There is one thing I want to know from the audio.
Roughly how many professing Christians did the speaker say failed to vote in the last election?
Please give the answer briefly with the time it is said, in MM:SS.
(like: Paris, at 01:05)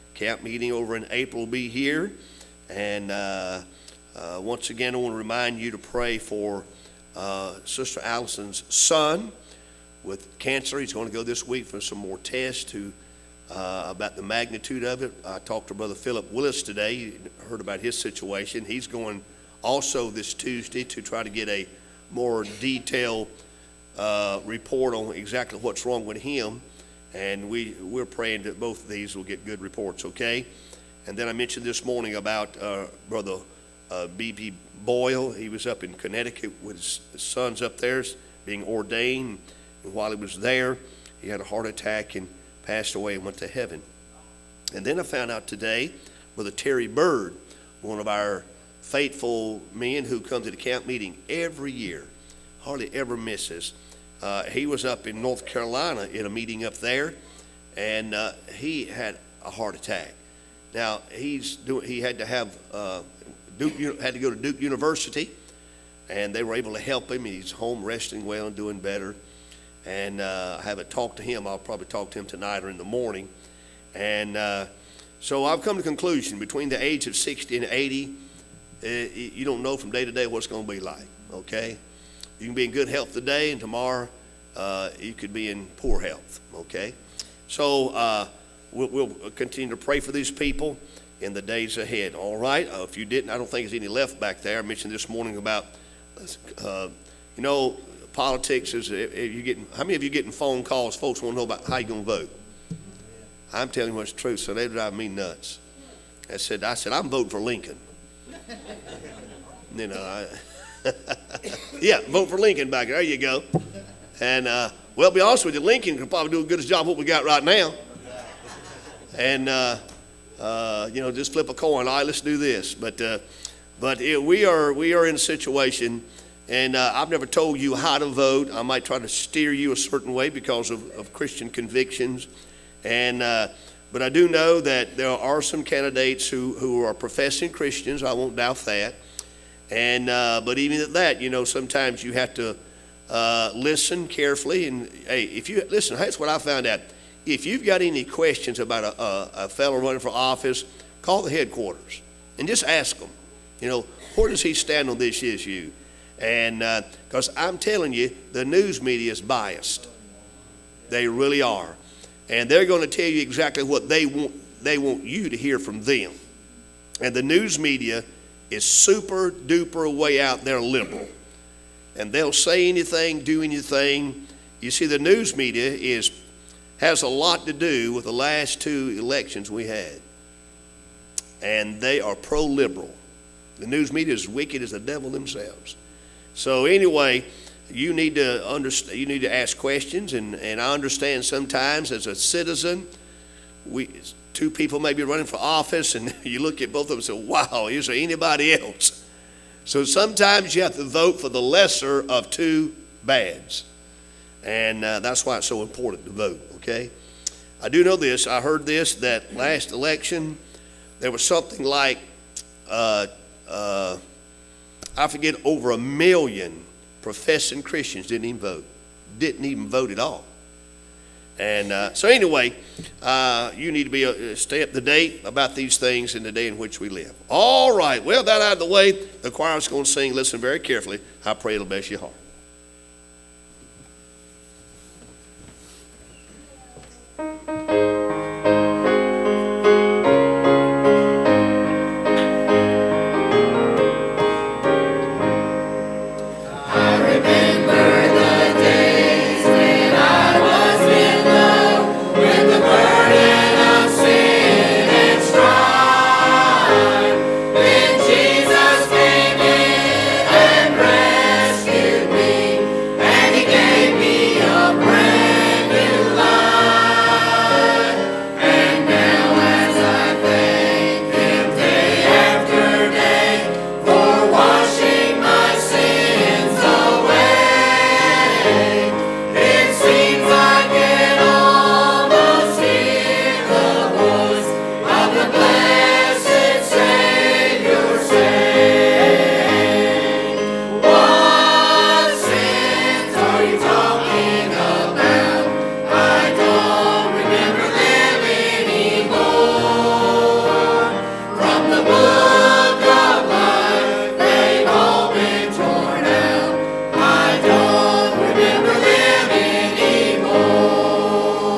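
Over a million, at 03:35.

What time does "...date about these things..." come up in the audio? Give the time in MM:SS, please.
03:44.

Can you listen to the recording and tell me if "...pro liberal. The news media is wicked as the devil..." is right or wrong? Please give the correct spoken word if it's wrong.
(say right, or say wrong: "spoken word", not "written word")
right.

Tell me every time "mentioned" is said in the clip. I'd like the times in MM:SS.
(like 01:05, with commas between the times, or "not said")
00:31, 01:34.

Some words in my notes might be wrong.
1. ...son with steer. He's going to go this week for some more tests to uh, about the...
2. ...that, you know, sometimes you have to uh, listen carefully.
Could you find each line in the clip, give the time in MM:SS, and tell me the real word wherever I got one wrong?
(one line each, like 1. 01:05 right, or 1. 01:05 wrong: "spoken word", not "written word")
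1. 00:08 wrong: "cancer", not "steer"
2. 02:20 right.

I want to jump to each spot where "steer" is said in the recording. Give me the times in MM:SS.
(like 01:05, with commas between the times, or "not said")
02:09.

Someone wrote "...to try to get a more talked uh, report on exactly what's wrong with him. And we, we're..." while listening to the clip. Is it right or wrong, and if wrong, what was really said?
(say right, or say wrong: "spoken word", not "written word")
wrong: "detailed", not "talked".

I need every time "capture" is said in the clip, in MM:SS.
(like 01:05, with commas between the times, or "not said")
not said.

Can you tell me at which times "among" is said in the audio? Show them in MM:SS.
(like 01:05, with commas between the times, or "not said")
not said.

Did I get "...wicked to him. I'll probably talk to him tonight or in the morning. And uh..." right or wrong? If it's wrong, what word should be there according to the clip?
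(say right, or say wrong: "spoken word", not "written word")
wrong: "talked", not "wicked".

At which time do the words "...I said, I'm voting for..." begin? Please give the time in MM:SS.
01:46.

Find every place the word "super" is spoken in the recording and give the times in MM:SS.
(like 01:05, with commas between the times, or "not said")
02:48.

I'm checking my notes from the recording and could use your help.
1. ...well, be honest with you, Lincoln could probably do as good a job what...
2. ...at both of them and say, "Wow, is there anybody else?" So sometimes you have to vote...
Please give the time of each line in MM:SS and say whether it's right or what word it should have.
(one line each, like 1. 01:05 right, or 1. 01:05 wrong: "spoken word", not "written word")
1. 01:54 right
2. 03:16 right.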